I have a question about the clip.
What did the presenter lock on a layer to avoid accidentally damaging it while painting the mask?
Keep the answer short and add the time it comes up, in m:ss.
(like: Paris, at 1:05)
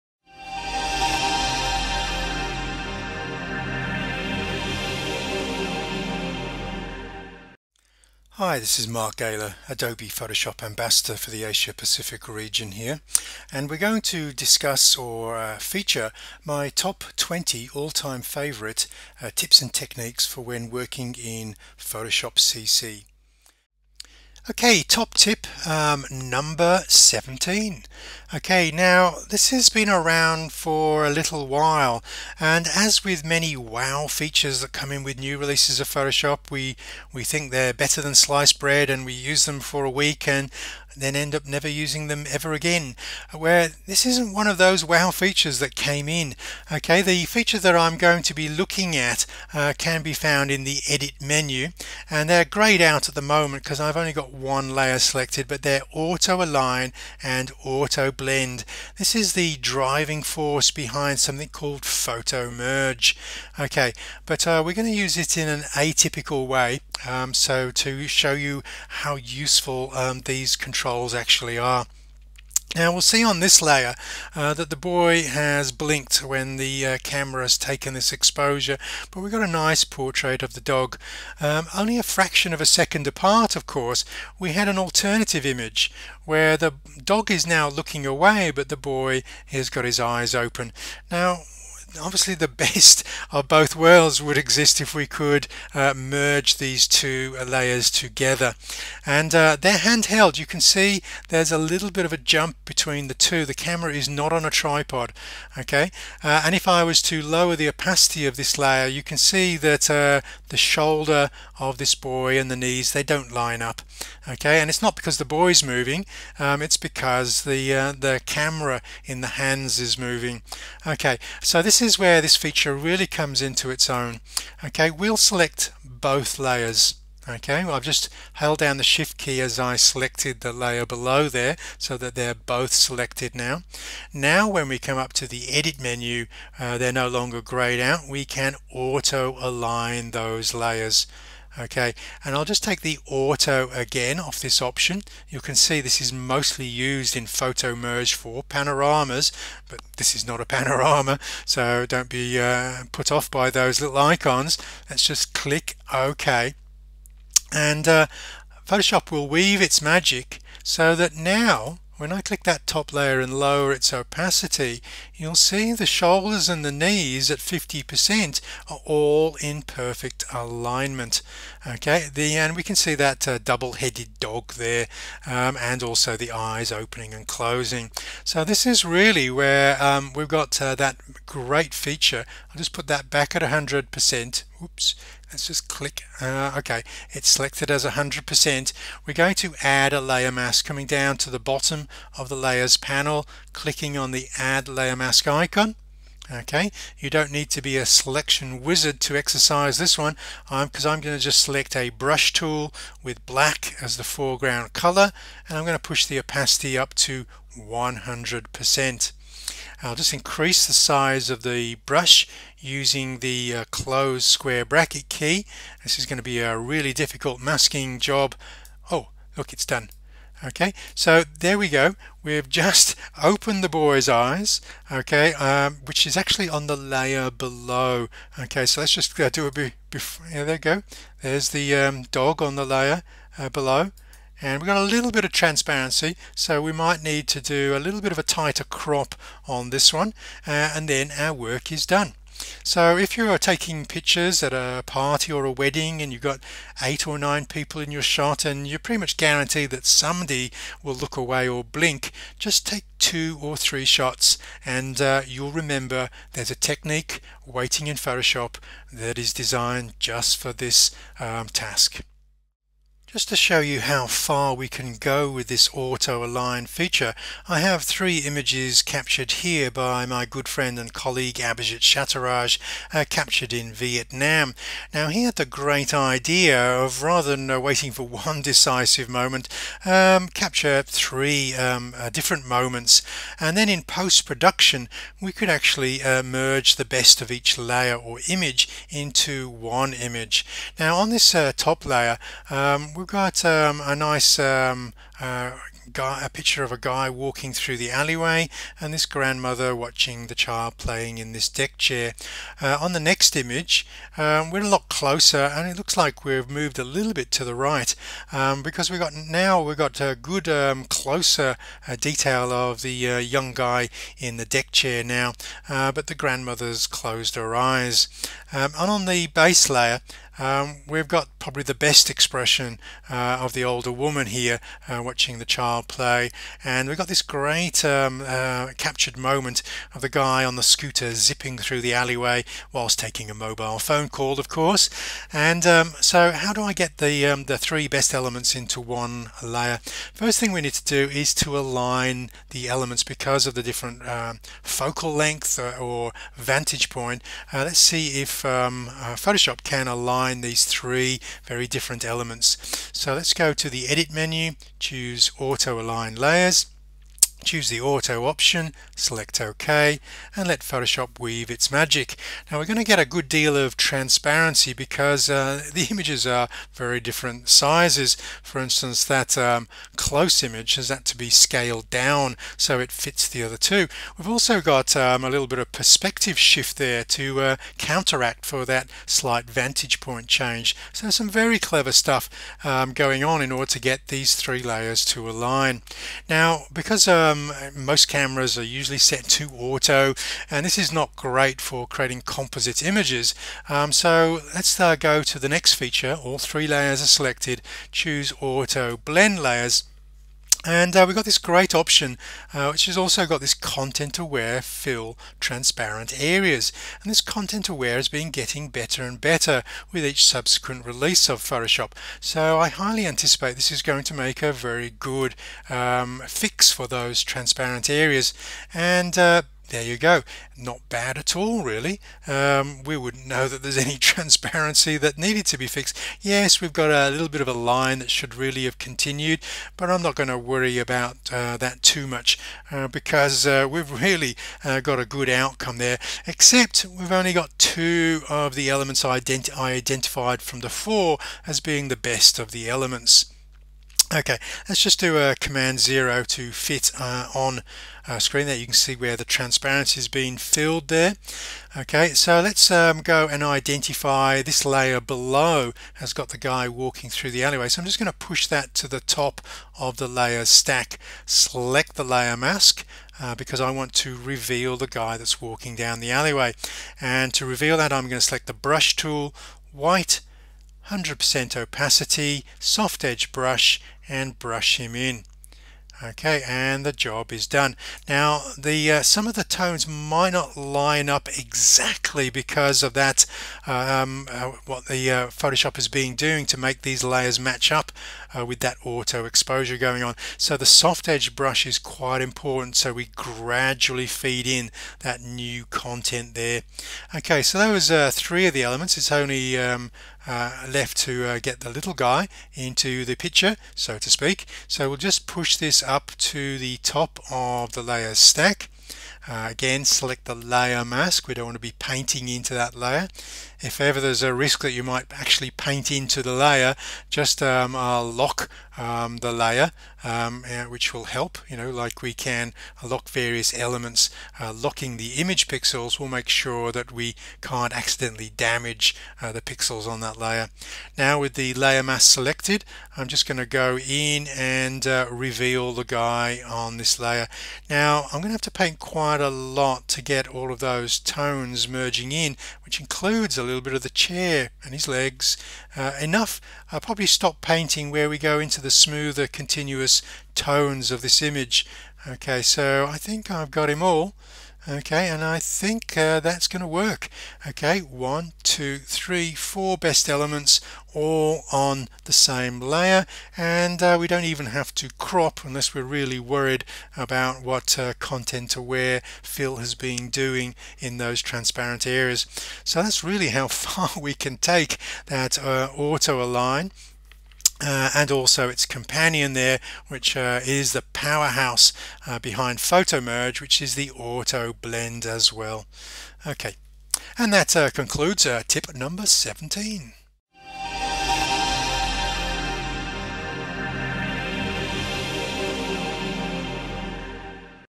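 Image pixels, at 8:45.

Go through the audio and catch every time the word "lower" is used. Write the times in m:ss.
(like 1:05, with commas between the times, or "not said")
1:47, 2:43.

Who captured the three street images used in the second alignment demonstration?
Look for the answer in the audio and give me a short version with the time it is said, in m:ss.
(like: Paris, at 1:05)
Abhijit Chattaraj, at 4:31.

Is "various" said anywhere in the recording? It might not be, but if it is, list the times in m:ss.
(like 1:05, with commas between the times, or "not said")
8:43.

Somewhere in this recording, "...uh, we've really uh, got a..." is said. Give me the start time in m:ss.
7:13.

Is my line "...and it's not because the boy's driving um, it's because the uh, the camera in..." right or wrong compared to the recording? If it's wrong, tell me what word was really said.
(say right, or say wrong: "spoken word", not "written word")
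wrong: "moving", not "driving".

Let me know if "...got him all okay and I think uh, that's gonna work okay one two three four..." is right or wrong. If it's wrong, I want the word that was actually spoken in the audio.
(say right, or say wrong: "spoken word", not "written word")
right.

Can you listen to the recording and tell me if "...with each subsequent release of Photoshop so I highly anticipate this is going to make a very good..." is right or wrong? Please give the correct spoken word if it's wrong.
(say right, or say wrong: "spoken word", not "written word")
right.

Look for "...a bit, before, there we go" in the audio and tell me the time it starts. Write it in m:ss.
3:49.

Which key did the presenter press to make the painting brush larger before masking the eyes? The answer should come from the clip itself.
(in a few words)
Close square bracket.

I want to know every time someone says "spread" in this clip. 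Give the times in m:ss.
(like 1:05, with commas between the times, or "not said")
not said.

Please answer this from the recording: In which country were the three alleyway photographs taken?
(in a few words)
Vietnam.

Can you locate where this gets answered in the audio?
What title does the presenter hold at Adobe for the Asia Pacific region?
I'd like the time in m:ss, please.
0:09.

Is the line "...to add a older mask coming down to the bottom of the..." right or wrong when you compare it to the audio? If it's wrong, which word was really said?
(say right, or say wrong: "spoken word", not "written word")
wrong: "layer", not "older".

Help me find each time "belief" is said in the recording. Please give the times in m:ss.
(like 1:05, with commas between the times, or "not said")
not said.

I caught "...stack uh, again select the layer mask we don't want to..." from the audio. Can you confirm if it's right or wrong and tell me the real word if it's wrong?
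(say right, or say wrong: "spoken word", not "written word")
right.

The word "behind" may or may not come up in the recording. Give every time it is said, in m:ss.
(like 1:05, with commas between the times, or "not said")
1:00, 9:42.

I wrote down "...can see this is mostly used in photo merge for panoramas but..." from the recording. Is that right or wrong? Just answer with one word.
right.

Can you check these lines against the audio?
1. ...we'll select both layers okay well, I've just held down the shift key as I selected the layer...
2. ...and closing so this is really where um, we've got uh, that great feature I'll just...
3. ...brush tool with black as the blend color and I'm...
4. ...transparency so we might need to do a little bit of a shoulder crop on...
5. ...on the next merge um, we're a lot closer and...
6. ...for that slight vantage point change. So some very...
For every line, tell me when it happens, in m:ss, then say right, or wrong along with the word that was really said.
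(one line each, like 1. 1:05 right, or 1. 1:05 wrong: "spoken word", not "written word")
1. 2:04 right
2. 2:57 right
3. 3:21 wrong: "foreground", not "blend"
4. 3:55 wrong: "tighter", not "shoulder"
5. 5:02 wrong: "image", not "merge"
6. 6:18 right.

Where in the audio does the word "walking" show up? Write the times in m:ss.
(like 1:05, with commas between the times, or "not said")
4:57, 7:36, 7:45.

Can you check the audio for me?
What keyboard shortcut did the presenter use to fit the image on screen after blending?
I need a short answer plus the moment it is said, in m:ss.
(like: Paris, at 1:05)
Command zero, at 7:25.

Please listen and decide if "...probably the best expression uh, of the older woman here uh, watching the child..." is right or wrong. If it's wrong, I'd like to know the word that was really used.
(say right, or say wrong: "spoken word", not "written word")
right.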